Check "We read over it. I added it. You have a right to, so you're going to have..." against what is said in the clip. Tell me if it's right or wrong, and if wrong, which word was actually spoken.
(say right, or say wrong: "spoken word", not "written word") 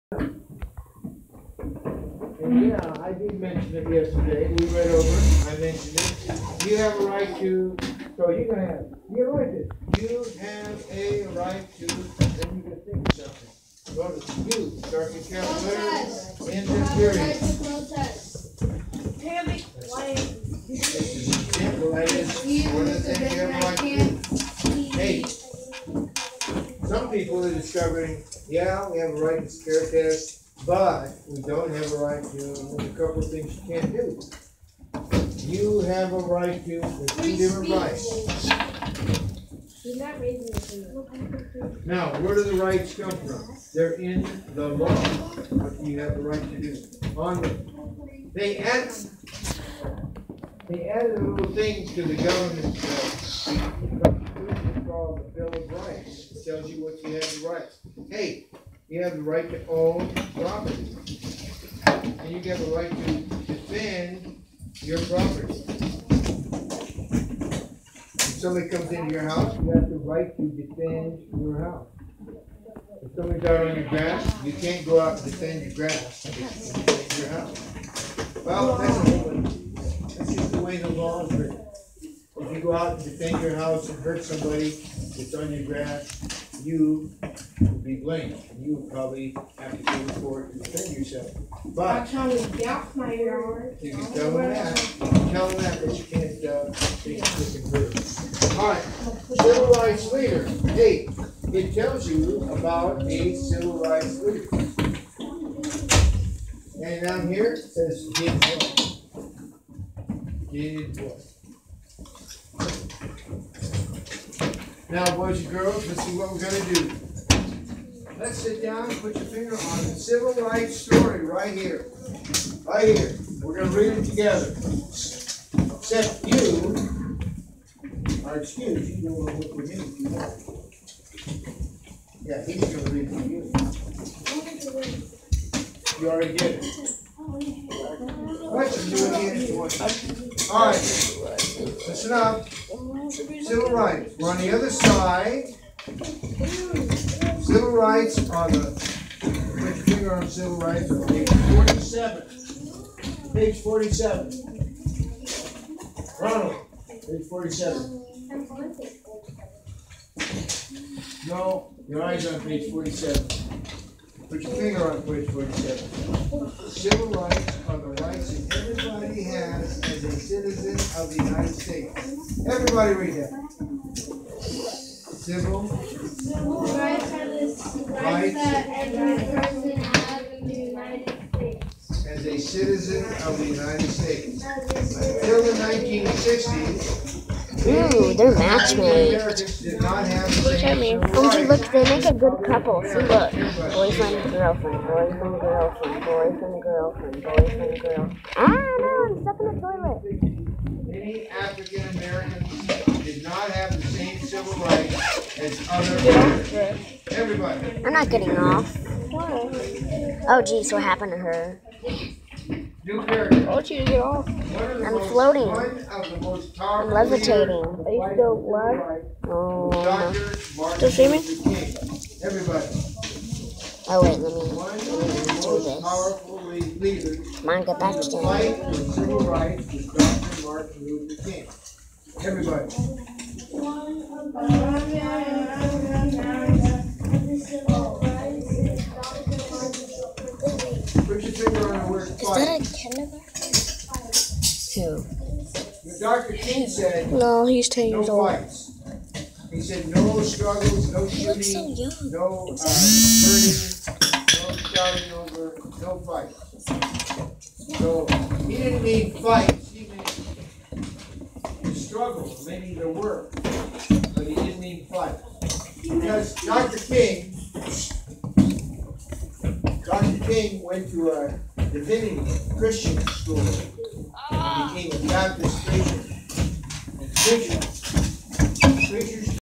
wrong: "mentioned", not "added".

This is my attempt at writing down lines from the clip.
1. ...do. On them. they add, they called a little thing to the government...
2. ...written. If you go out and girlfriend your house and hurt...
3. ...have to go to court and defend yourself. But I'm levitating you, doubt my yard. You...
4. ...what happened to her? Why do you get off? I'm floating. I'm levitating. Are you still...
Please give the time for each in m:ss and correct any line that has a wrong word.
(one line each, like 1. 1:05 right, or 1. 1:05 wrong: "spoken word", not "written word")
1. 0:46 wrong: "added", not "called"
2. 1:21 wrong: "defend", not "girlfriend"
3. 1:29 wrong: "telling", not "levitating"
4. 3:30 right.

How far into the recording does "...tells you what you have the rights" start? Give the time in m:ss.
0:56.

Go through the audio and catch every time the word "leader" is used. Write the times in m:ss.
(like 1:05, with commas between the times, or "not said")
1:40, 1:44.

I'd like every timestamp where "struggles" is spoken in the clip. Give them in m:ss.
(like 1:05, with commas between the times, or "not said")
4:10, 4:21.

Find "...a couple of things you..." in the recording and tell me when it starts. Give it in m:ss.
0:32.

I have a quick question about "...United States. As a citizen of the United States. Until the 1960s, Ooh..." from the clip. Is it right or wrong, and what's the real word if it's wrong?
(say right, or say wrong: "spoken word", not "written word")
right.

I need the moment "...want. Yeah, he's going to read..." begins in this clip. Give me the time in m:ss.
2:10.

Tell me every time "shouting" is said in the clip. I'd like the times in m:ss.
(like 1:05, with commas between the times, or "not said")
4:14.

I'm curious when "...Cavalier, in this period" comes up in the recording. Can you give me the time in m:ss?
0:15.